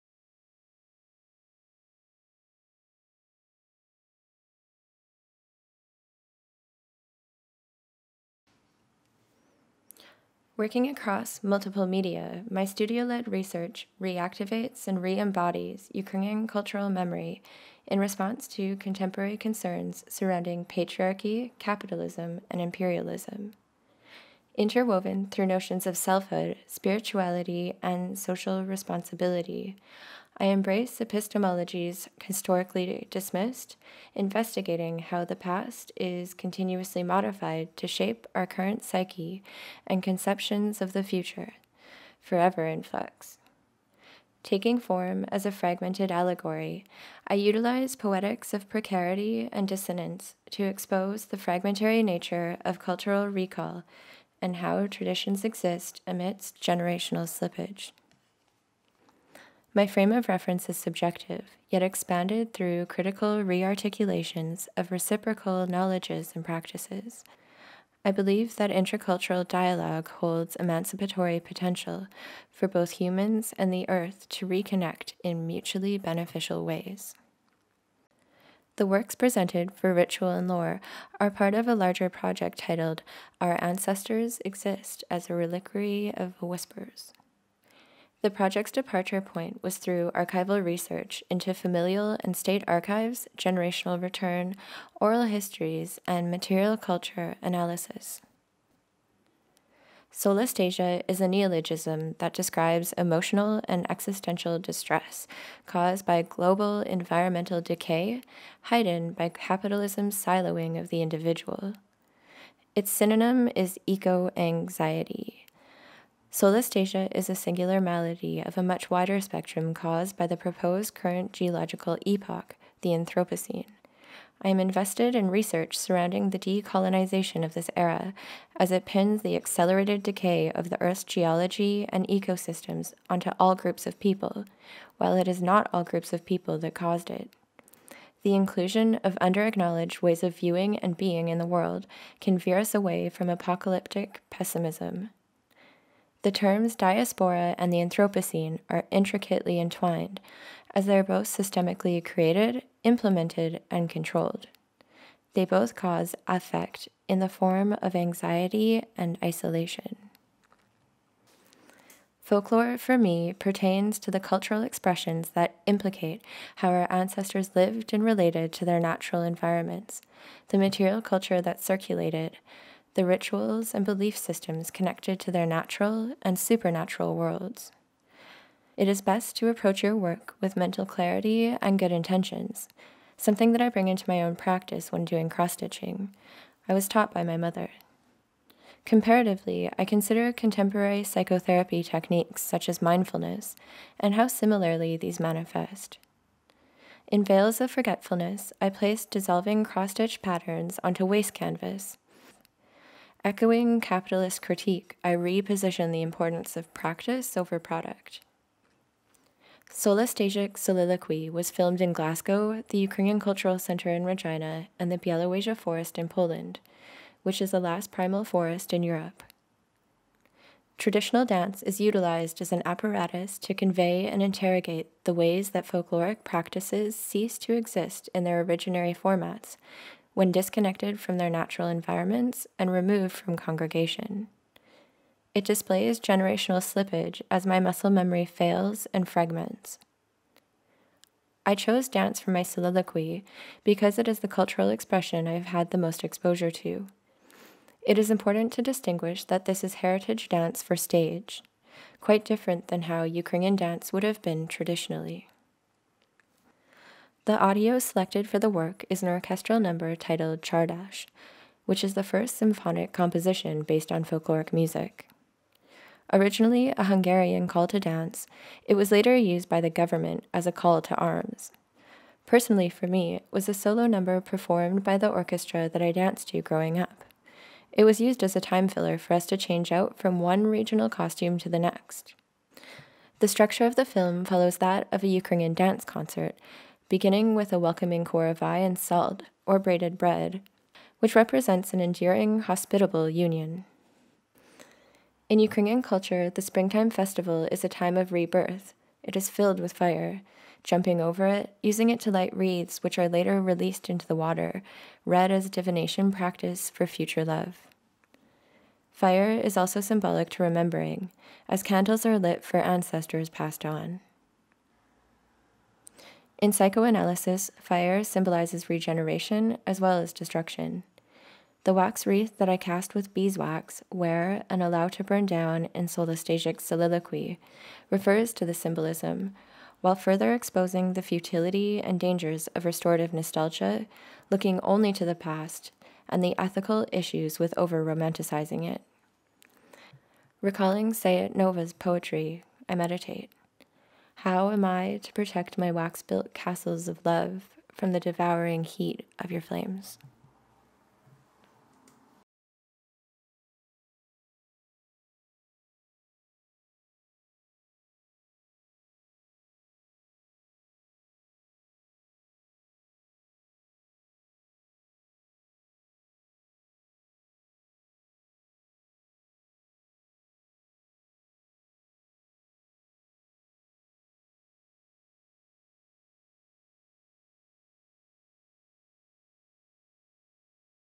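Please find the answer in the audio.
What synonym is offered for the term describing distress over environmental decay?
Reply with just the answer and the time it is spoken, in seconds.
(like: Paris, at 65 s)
Eco anxiety, at 113 s.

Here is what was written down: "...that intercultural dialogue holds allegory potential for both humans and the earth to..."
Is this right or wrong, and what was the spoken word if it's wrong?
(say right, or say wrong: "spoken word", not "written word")
wrong: "emancipatory", not "allegory".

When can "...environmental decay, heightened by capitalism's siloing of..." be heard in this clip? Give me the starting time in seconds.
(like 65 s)
106 s.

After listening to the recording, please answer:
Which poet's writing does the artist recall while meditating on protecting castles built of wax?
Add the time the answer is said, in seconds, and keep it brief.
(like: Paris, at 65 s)
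Sayat Nova, at 340 s.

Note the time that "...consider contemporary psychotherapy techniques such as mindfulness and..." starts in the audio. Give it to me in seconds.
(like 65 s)
189 s.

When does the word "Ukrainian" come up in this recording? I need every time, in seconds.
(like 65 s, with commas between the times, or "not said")
15 s, 212 s, 253 s, 285 s, 295 s.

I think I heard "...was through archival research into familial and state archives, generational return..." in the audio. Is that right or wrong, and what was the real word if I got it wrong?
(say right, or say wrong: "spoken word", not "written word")
right.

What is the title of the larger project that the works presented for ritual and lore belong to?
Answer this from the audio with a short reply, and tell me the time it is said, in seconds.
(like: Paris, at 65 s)
Our Ancestors Exist as a Reliquary of Whispers, at 83 s.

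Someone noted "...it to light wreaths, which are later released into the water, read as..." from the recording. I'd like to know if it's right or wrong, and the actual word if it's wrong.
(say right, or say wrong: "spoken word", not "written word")
right.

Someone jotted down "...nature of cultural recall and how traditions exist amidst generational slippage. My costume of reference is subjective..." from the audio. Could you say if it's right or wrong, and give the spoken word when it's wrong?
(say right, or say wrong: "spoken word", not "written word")
wrong: "frame", not "costume".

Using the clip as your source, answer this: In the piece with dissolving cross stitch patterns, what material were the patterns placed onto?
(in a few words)
Waste canvas.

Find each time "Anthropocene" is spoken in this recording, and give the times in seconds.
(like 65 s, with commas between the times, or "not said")
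122 s, 147 s.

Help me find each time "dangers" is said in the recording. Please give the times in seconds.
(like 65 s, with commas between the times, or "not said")
331 s.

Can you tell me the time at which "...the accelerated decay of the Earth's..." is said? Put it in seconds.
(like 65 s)
129 s.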